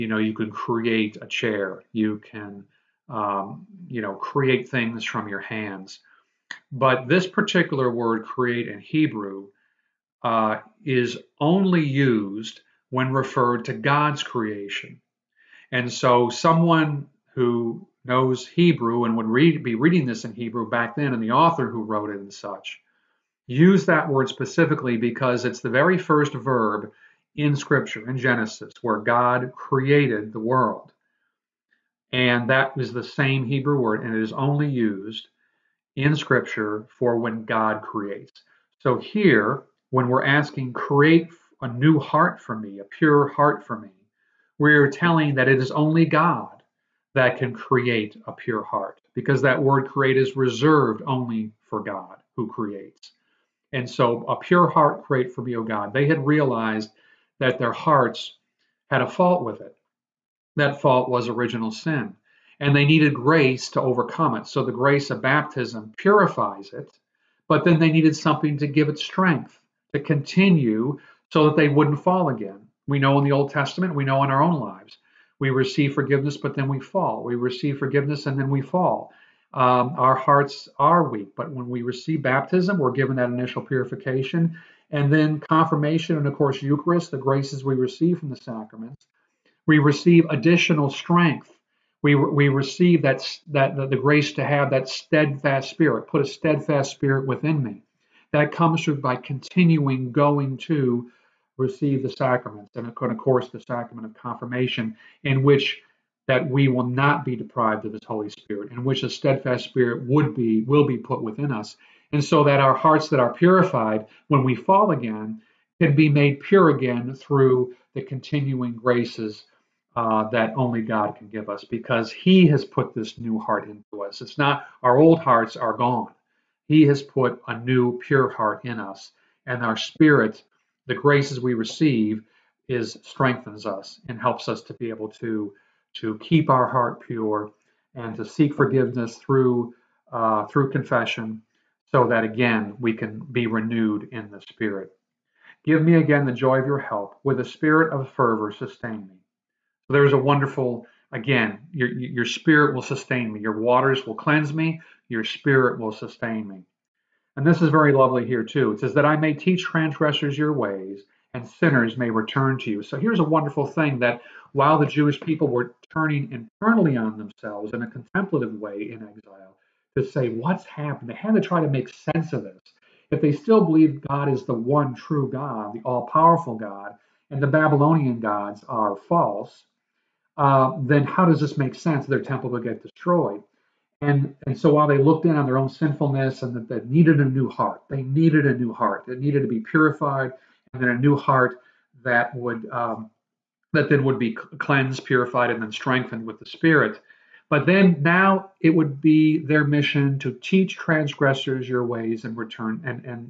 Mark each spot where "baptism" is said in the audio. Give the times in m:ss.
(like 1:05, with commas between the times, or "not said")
1:05, 1:22.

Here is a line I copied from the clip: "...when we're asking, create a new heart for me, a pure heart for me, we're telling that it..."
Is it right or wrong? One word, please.
right.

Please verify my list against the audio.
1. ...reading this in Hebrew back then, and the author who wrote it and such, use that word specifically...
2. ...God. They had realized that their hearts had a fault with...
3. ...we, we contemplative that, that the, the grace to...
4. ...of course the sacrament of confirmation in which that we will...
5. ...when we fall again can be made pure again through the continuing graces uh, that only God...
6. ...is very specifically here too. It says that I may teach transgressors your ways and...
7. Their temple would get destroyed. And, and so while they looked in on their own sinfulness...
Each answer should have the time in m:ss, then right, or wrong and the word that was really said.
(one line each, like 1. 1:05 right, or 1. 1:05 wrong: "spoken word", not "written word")
1. 0:19 right
2. 0:55 right
3. 1:32 wrong: "receive", not "contemplative"
4. 1:42 right
5. 1:54 right
6. 2:37 wrong: "lovely", not "specifically"
7. 3:02 right.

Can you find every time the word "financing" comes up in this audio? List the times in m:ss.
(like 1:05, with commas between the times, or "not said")
not said.